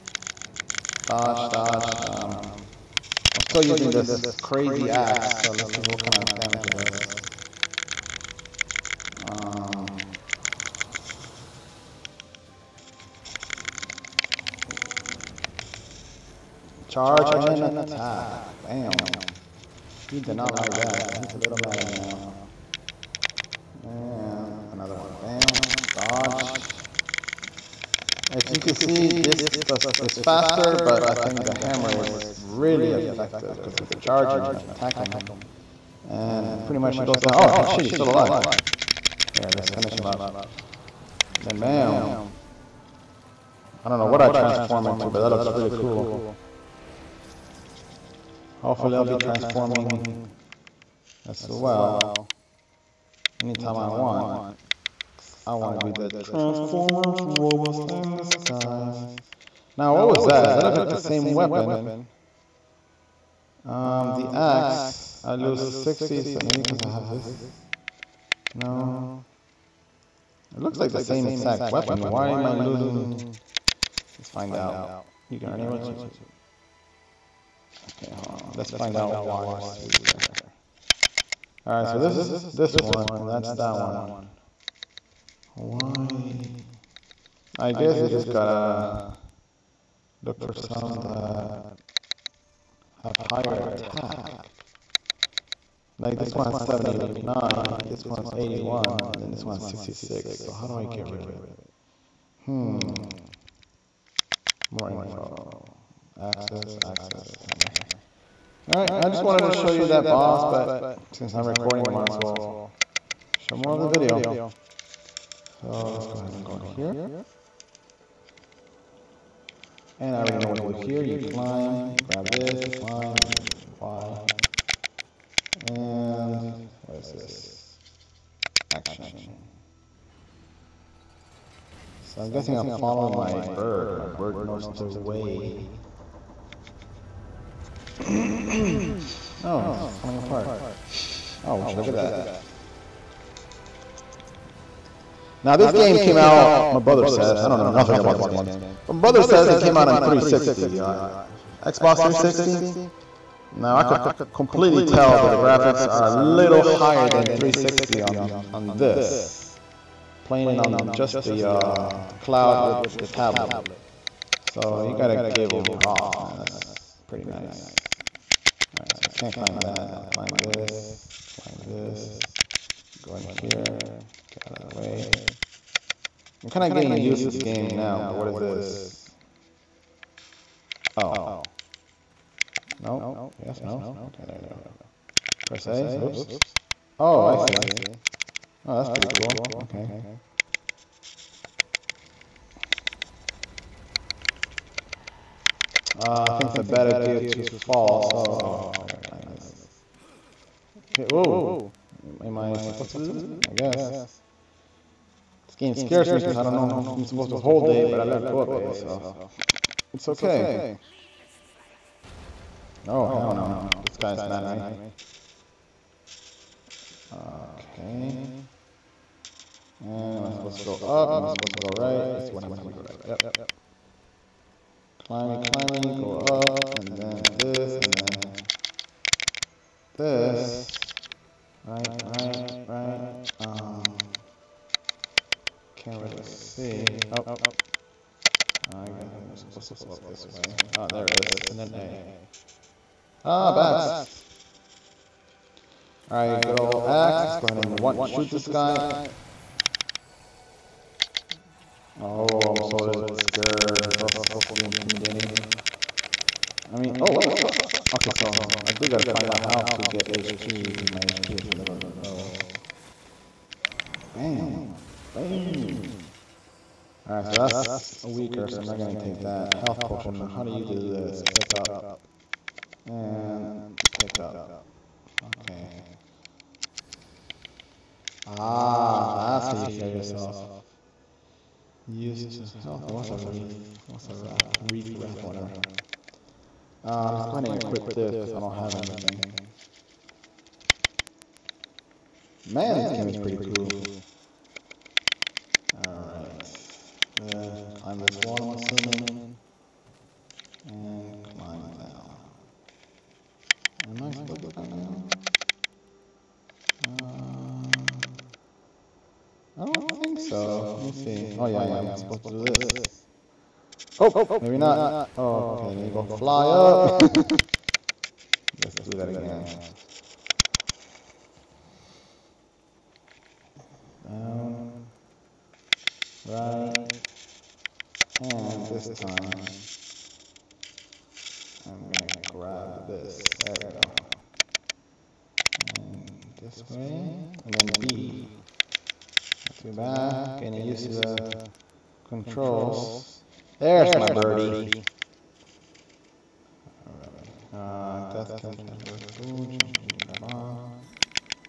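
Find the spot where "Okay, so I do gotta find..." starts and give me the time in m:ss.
4:17.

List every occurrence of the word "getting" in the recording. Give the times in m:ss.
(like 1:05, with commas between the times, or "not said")
2:56, 5:40.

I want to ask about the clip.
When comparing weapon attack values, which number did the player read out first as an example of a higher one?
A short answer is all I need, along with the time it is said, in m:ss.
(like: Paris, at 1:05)
79, at 1:36.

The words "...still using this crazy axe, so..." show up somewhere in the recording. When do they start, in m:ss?
0:03.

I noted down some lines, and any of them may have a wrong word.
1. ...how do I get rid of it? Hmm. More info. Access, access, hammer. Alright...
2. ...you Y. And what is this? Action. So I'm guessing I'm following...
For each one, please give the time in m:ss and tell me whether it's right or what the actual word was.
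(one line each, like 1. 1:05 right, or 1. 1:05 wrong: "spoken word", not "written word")
1. 1:40 right
2. 2:03 right.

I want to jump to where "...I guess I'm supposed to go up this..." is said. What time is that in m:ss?
3:58.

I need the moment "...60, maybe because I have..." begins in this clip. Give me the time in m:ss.
1:05.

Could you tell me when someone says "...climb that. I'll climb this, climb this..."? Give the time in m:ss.
2:49.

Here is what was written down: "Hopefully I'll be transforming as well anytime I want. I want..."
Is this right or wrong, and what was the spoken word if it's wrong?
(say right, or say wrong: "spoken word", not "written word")
right.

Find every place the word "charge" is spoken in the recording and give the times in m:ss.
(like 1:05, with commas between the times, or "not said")
0:16, 0:33.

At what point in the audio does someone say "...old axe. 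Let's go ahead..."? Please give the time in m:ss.
4:06.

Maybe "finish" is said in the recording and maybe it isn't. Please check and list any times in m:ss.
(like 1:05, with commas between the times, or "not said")
0:39.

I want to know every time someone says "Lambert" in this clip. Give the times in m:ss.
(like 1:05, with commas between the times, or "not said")
not said.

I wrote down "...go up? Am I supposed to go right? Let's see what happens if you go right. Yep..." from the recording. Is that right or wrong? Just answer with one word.
right.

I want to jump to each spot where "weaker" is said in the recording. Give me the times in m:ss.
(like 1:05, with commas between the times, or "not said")
1:19, 4:28.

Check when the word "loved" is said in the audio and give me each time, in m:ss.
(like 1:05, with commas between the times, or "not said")
not said.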